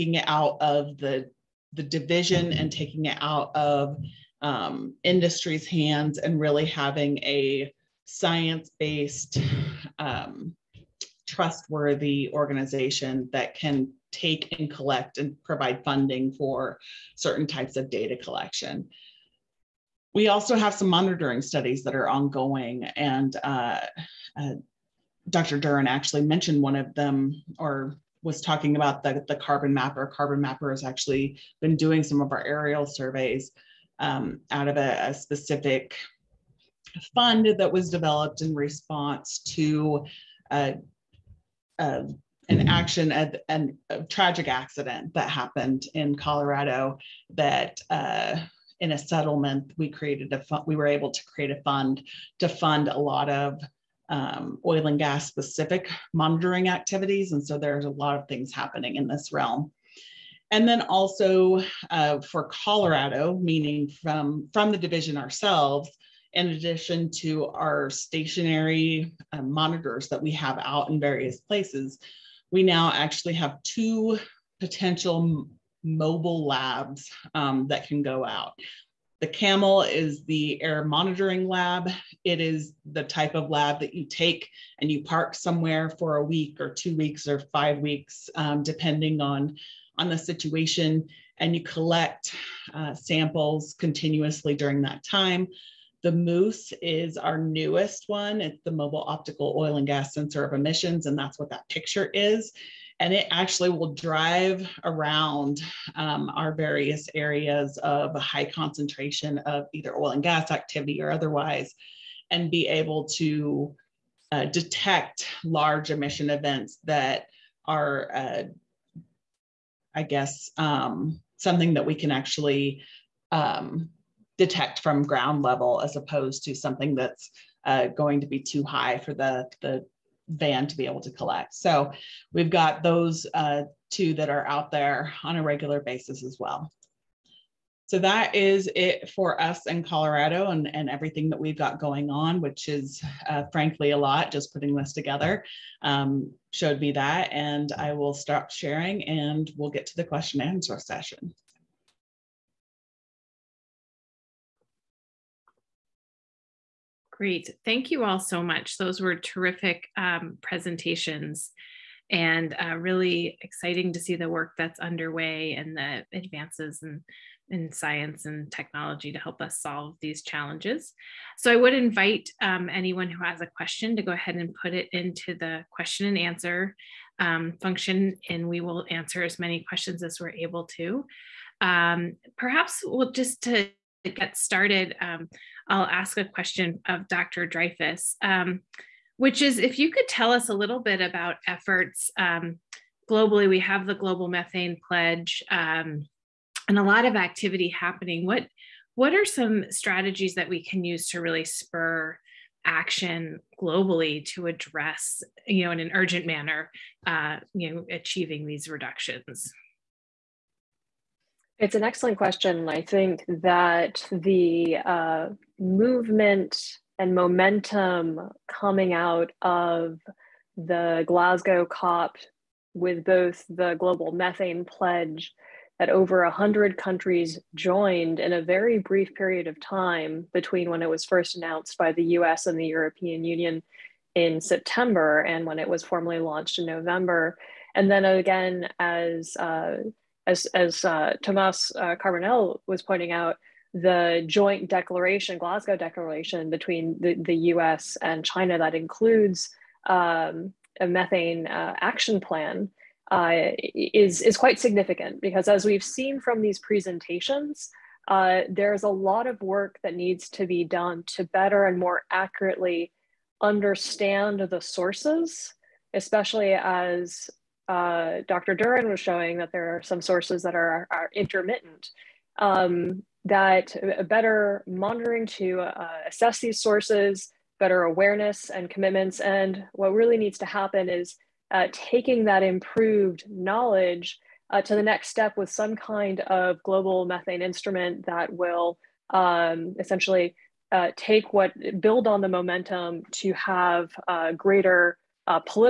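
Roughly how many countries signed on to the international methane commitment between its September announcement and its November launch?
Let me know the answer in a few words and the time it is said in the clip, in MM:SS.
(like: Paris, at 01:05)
over 100, at 03:45.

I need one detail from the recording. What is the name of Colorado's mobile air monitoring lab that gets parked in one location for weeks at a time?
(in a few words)
CAMEL.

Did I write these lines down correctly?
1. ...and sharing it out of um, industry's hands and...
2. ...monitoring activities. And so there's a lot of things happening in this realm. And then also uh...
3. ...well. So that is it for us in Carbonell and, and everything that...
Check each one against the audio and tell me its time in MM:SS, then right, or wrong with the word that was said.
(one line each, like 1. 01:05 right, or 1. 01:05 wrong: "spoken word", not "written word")
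1. 00:02 wrong: "taking", not "sharing"
2. 00:56 right
3. 02:16 wrong: "Colorado", not "Carbonell".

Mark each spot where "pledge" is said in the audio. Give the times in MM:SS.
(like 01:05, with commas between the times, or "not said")
03:14, 03:44.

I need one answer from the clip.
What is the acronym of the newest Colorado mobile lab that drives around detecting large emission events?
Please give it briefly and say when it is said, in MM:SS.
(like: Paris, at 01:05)
Moose, at 01:36.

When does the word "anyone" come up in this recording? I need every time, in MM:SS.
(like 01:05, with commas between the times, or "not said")
02:52.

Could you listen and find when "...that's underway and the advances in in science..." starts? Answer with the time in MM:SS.
02:44.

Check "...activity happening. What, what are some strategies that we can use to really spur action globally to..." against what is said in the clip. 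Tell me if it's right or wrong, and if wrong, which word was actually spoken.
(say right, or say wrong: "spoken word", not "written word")
right.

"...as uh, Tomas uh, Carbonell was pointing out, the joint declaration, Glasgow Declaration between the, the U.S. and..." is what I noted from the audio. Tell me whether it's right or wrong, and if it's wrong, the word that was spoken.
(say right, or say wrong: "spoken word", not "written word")
right.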